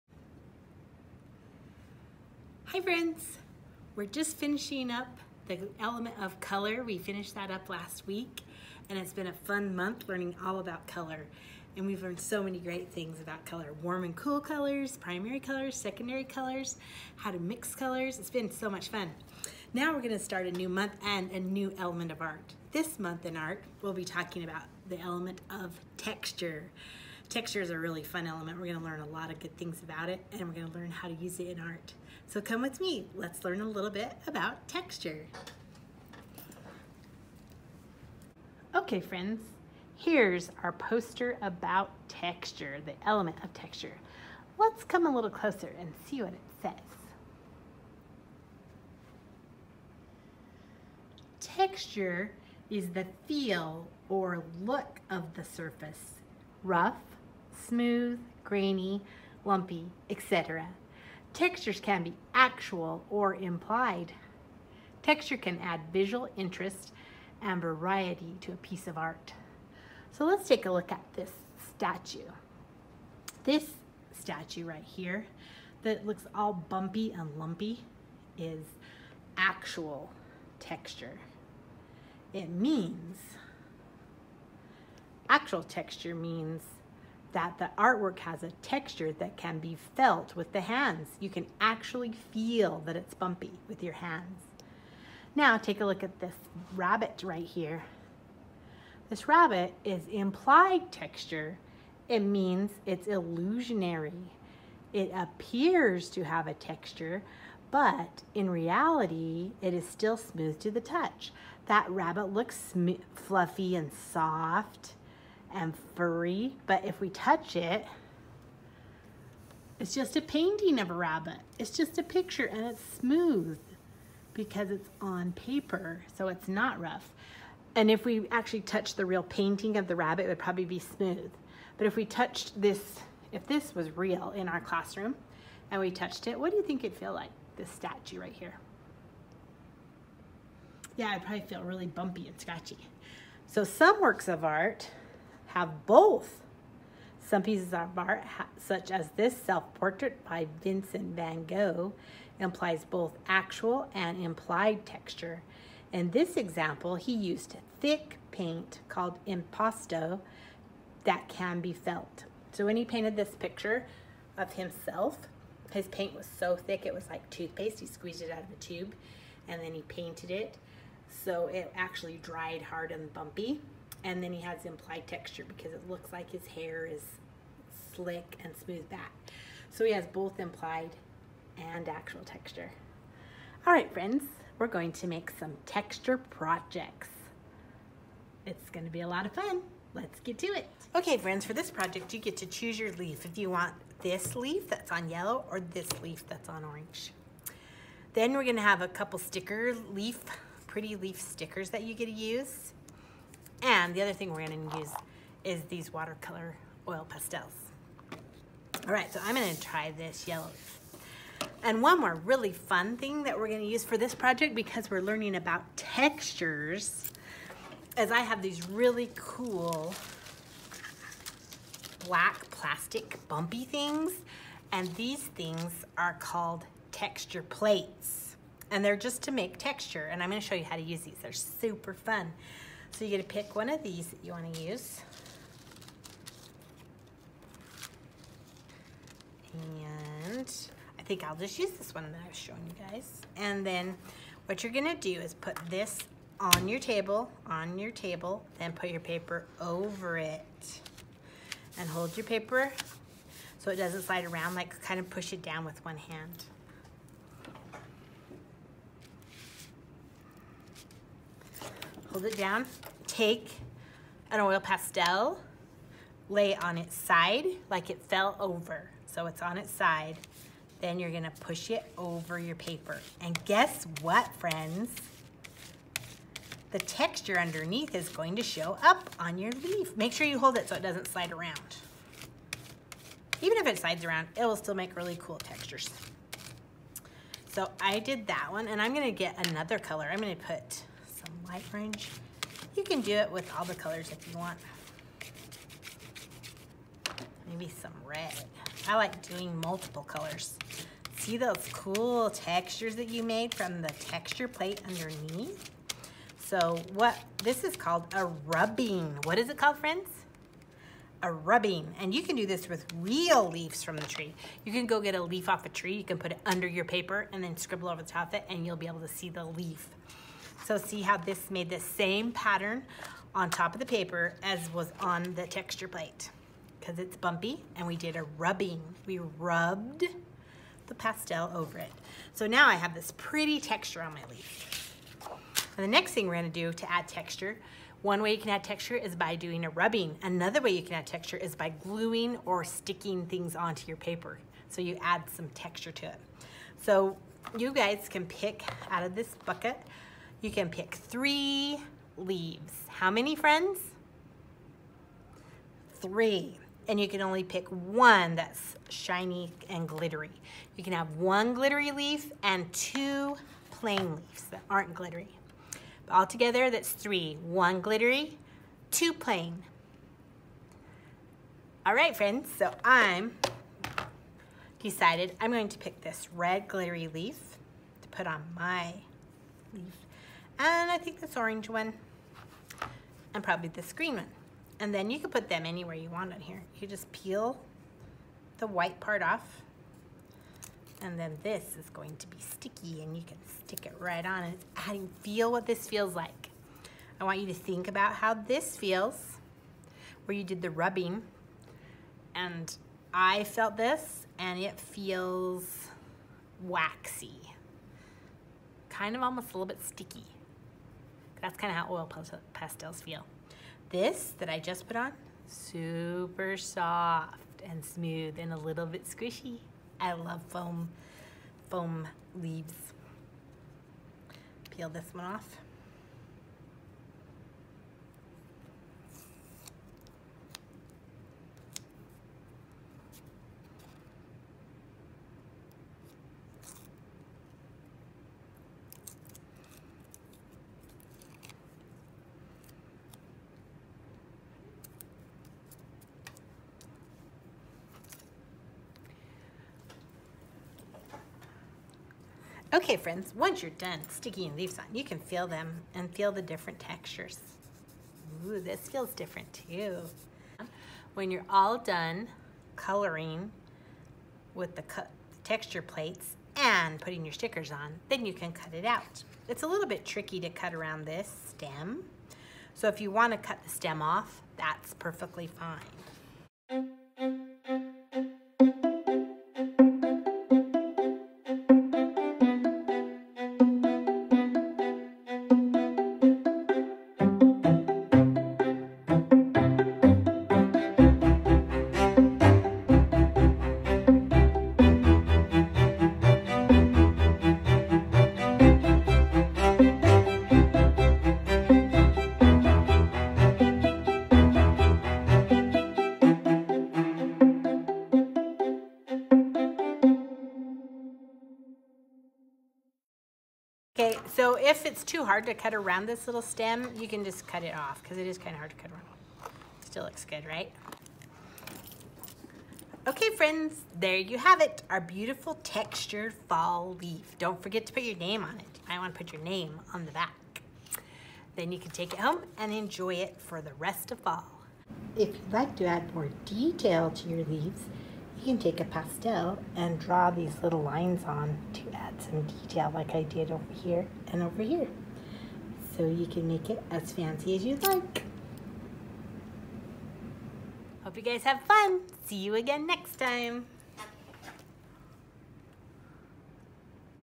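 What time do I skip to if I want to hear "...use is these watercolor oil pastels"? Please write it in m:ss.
3:24.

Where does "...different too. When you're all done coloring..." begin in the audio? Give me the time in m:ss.
7:39.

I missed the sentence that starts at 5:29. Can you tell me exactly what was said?
We rubbed the pastel over it.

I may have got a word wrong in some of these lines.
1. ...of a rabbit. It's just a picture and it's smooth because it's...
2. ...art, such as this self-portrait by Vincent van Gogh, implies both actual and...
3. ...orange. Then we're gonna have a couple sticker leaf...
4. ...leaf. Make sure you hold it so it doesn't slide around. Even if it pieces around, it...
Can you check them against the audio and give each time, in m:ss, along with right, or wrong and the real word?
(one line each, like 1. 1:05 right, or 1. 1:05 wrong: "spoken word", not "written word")
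1. 2:00 right
2. 2:27 right
3. 3:16 right
4. 4:39 wrong: "slides", not "pieces".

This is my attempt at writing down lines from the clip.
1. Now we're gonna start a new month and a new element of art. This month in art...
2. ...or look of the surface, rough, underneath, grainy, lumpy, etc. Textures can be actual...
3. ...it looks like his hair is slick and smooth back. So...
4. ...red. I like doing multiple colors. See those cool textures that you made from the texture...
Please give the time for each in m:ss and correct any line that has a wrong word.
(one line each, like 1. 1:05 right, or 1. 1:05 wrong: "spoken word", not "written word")
1. 0:19 right
2. 0:54 wrong: "smooth", not "underneath"
3. 2:55 right
4. 4:58 right.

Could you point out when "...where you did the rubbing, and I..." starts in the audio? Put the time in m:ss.
6:40.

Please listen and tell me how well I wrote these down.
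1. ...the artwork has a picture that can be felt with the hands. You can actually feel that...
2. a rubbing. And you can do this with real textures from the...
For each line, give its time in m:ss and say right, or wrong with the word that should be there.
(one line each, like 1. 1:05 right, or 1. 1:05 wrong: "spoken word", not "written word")
1. 1:27 wrong: "texture", not "picture"
2. 5:11 wrong: "leaves", not "textures".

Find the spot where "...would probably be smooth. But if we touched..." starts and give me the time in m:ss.
2:10.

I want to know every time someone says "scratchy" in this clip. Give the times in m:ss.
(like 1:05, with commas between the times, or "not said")
2:22.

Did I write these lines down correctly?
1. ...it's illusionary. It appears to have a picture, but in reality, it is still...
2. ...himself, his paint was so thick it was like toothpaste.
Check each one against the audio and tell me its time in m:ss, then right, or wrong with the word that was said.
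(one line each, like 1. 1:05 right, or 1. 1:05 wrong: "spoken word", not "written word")
1. 1:42 wrong: "texture", not "picture"
2. 2:44 right.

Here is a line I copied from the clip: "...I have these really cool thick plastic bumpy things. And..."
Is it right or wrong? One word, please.
wrong.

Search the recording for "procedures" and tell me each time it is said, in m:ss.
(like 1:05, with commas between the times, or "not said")
not said.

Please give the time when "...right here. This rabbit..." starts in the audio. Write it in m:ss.
1:37.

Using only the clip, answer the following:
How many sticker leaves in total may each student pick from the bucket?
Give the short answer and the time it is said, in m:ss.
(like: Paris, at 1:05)
3, at 5:50.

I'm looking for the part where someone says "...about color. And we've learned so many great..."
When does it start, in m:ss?
0:10.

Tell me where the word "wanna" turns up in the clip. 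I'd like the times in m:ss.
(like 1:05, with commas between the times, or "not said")
3:54, 7:53.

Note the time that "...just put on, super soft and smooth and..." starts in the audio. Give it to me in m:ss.
6:54.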